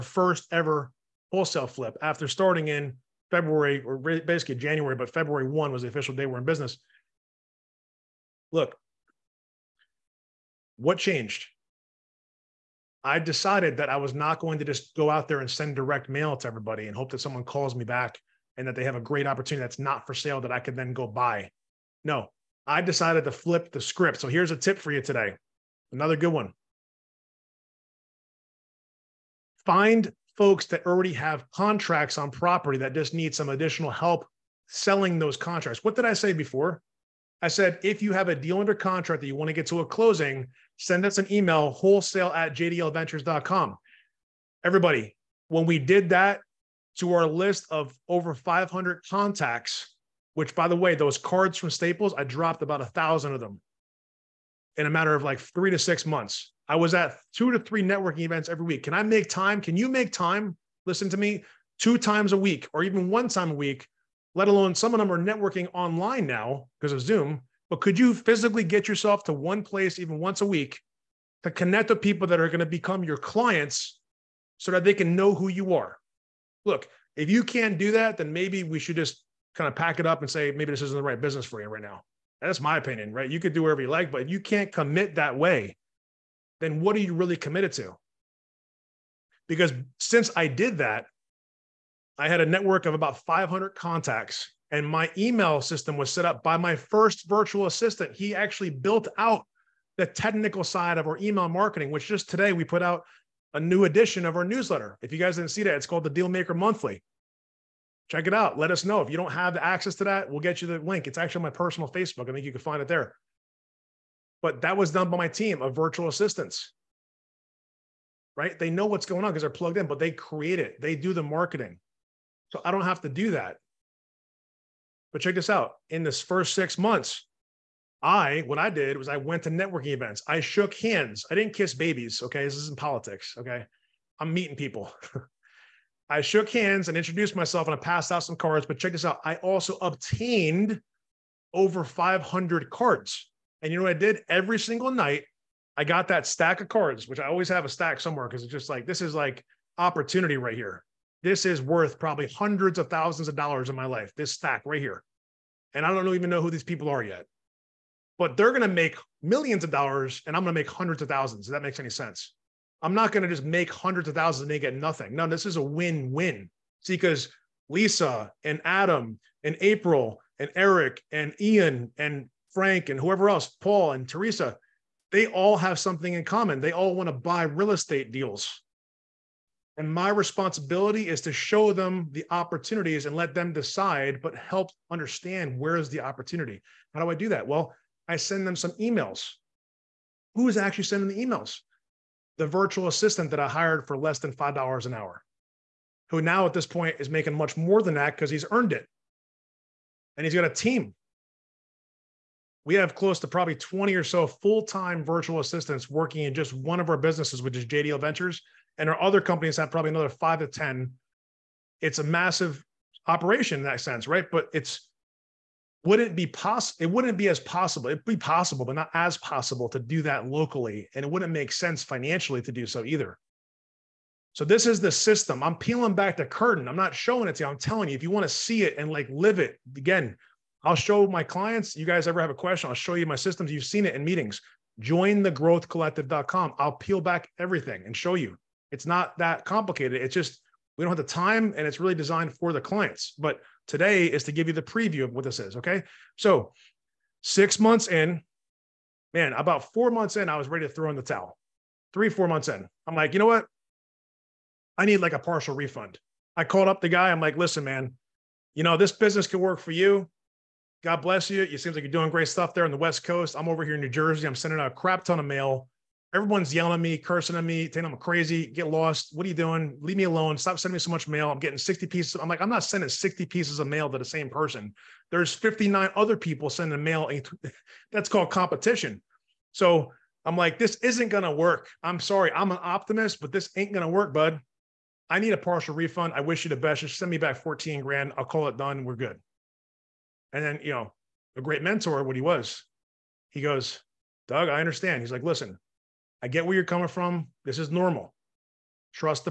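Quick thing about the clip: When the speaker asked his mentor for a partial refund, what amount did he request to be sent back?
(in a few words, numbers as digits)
$14,000.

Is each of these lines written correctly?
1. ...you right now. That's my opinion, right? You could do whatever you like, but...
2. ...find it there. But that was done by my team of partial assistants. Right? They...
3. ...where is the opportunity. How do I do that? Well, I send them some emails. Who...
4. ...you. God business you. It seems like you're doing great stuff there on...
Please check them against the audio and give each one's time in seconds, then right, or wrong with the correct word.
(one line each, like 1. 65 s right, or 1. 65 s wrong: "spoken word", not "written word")
1. 81 s right
2. 112 s wrong: "virtual", not "partial"
3. 185 s right
4. 259 s wrong: "bless", not "business".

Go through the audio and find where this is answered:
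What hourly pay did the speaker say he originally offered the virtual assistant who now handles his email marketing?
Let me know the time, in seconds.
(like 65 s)
193 s.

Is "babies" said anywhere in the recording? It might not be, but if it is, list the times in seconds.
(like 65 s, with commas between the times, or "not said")
131 s.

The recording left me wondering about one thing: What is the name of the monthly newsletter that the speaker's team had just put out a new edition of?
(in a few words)
Dealmaker Monthly.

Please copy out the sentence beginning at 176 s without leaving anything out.
They all want to buy real estate deals.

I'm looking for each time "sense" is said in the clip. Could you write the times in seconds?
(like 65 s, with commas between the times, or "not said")
161 s, 213 s, 221 s.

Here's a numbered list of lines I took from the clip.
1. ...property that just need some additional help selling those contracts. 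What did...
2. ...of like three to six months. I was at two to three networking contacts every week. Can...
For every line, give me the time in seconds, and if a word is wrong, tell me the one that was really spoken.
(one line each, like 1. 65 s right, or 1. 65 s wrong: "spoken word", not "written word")
1. 32 s right
2. 55 s wrong: "events", not "contacts".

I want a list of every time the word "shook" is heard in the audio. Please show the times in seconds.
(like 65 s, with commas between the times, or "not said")
130 s, 136 s.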